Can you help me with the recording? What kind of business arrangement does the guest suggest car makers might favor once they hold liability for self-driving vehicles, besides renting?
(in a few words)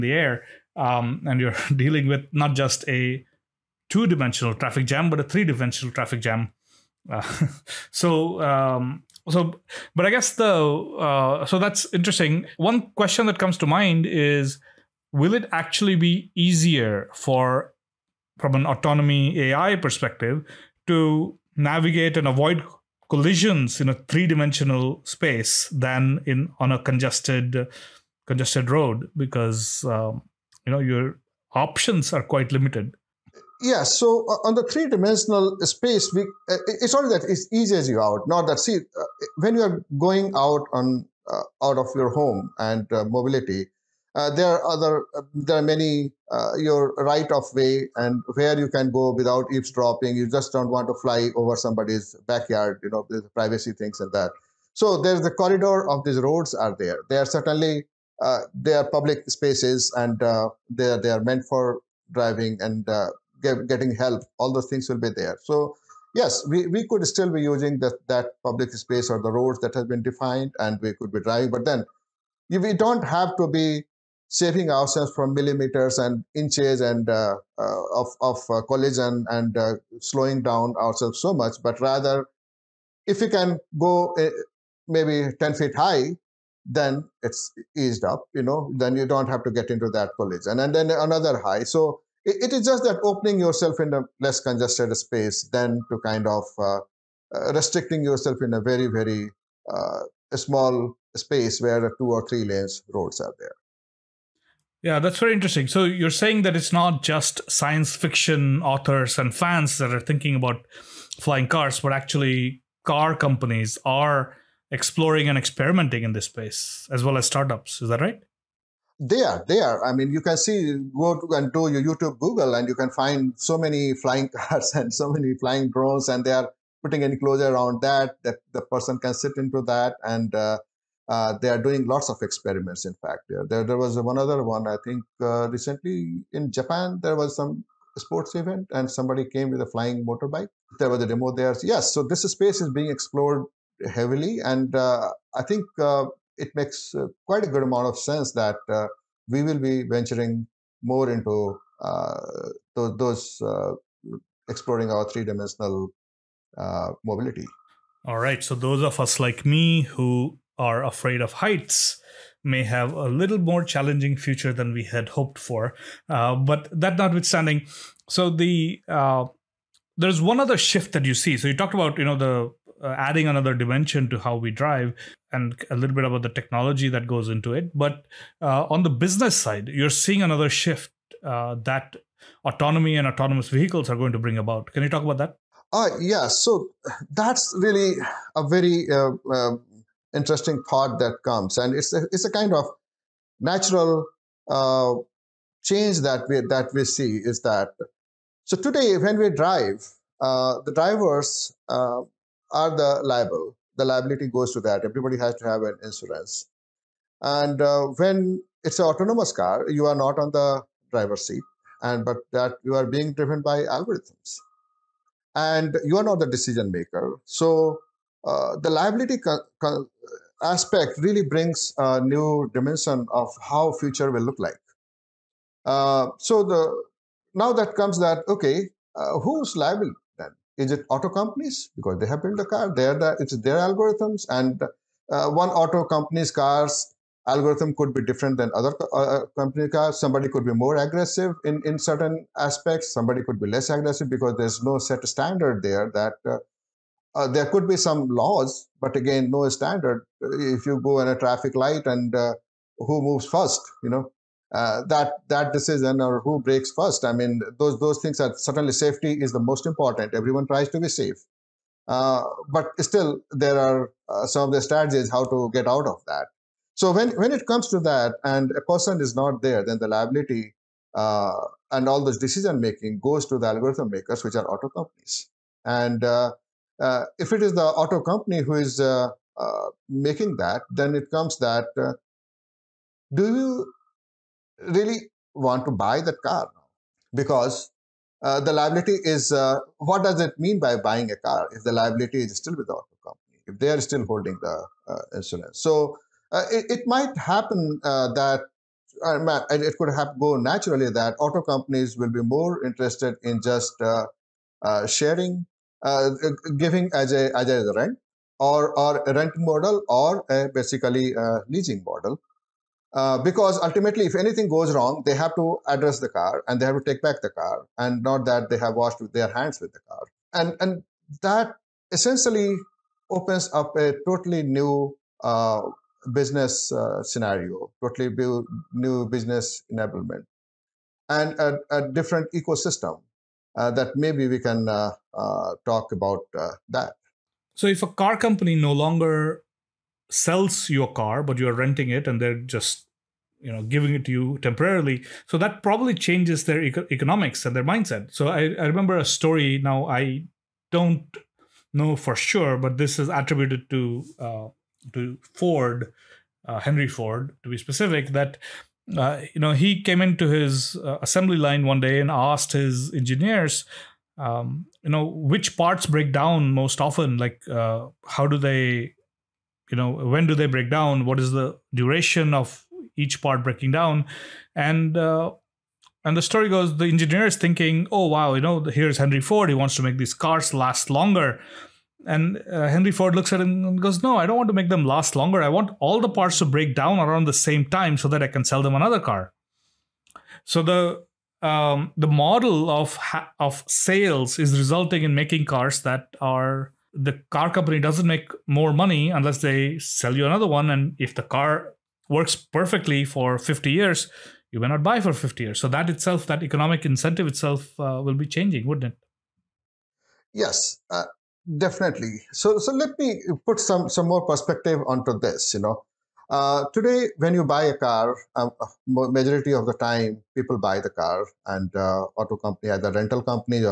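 leasing model.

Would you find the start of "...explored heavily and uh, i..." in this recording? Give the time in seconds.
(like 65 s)
142 s.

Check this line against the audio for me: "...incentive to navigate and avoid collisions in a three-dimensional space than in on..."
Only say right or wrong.
wrong.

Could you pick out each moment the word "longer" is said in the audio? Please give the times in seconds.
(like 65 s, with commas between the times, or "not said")
338 s, 380 s, 385 s.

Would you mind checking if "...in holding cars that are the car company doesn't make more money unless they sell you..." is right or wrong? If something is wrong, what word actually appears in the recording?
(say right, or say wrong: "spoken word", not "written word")
wrong: "making", not "holding".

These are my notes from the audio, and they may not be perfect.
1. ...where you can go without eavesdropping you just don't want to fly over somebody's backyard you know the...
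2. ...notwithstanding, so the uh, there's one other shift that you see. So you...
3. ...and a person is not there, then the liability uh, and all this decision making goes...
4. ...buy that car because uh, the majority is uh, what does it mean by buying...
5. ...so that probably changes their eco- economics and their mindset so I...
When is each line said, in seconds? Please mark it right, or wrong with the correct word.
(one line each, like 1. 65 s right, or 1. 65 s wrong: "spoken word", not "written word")
1. 48 s right
2. 166 s right
3. 268 s right
4. 285 s wrong: "liability", not "majority"
5. 345 s right.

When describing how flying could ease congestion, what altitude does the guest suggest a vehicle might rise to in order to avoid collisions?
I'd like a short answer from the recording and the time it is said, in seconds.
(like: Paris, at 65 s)
10 feet, at 85 s.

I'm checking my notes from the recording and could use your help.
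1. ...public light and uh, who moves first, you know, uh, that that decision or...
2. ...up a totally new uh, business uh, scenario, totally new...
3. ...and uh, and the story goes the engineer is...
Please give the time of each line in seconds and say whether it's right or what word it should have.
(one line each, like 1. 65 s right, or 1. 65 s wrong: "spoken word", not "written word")
1. 251 s wrong: "traffic", not "public"
2. 323 s right
3. 374 s right.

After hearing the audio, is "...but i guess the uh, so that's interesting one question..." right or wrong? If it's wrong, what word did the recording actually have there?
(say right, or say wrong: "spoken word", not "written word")
right.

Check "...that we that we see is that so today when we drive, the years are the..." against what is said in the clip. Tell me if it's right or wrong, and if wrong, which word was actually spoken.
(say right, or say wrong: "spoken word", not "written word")
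wrong: "drivers", not "years".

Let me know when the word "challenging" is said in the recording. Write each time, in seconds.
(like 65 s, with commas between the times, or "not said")
163 s.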